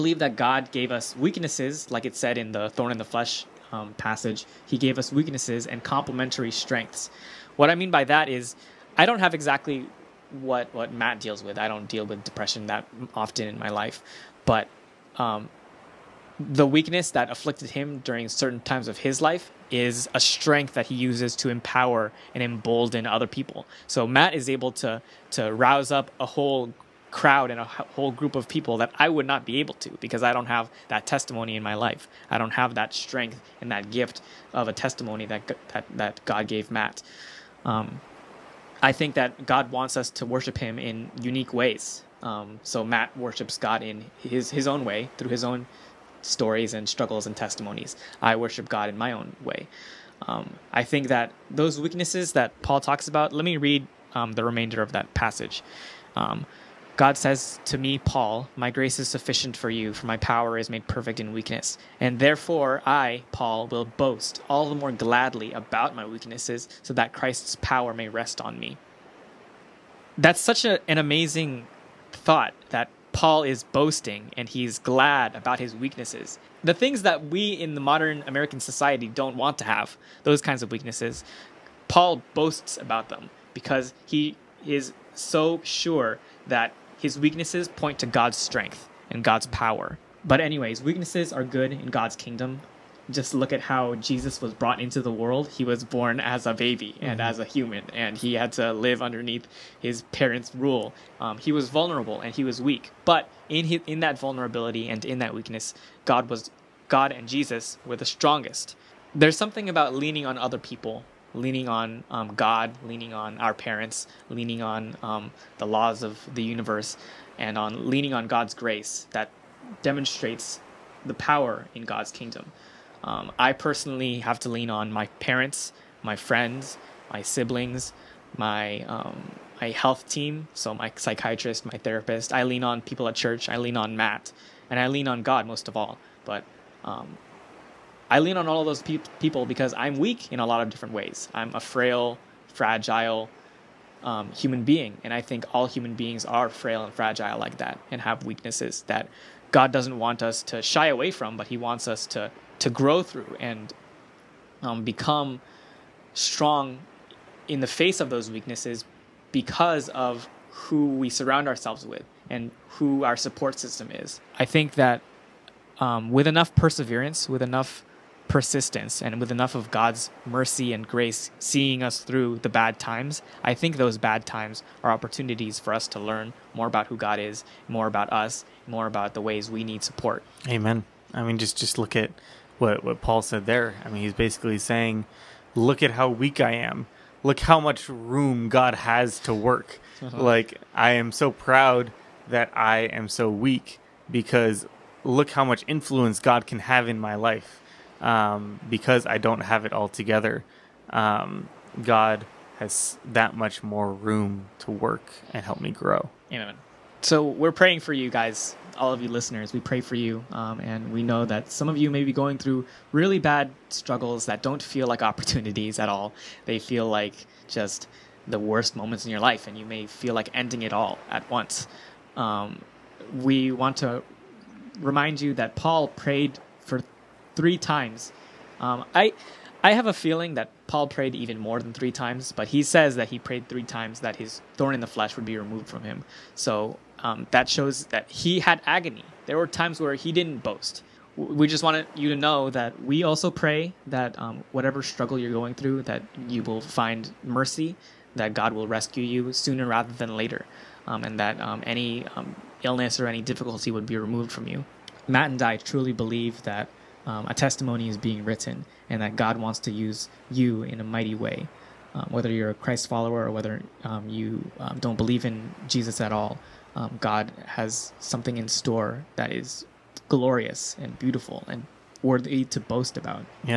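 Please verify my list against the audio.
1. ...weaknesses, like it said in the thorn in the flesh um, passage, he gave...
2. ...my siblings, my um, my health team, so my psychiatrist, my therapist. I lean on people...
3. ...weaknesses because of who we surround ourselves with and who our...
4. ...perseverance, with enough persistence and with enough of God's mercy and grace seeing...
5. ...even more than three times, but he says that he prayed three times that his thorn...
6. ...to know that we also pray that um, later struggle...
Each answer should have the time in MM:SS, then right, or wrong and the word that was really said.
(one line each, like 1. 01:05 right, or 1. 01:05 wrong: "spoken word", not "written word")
1. 00:01 right
2. 02:07 right
3. 02:38 right
4. 02:46 right
5. 03:51 right
6. 04:02 wrong: "whatever", not "later".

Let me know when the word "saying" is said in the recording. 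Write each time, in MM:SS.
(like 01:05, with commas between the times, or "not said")
03:04.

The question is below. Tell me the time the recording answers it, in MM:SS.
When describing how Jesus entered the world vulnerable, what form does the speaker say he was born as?
01:36.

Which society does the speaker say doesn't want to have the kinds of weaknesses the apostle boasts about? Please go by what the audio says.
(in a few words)
Modern American society.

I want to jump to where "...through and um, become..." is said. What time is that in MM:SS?
02:33.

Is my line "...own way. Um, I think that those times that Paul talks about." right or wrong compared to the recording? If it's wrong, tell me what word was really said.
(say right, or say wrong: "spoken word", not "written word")
wrong: "weaknesses", not "times".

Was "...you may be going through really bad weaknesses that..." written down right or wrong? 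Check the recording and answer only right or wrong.
wrong.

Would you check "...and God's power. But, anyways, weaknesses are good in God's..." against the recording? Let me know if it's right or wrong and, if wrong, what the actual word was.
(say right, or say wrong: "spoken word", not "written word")
right.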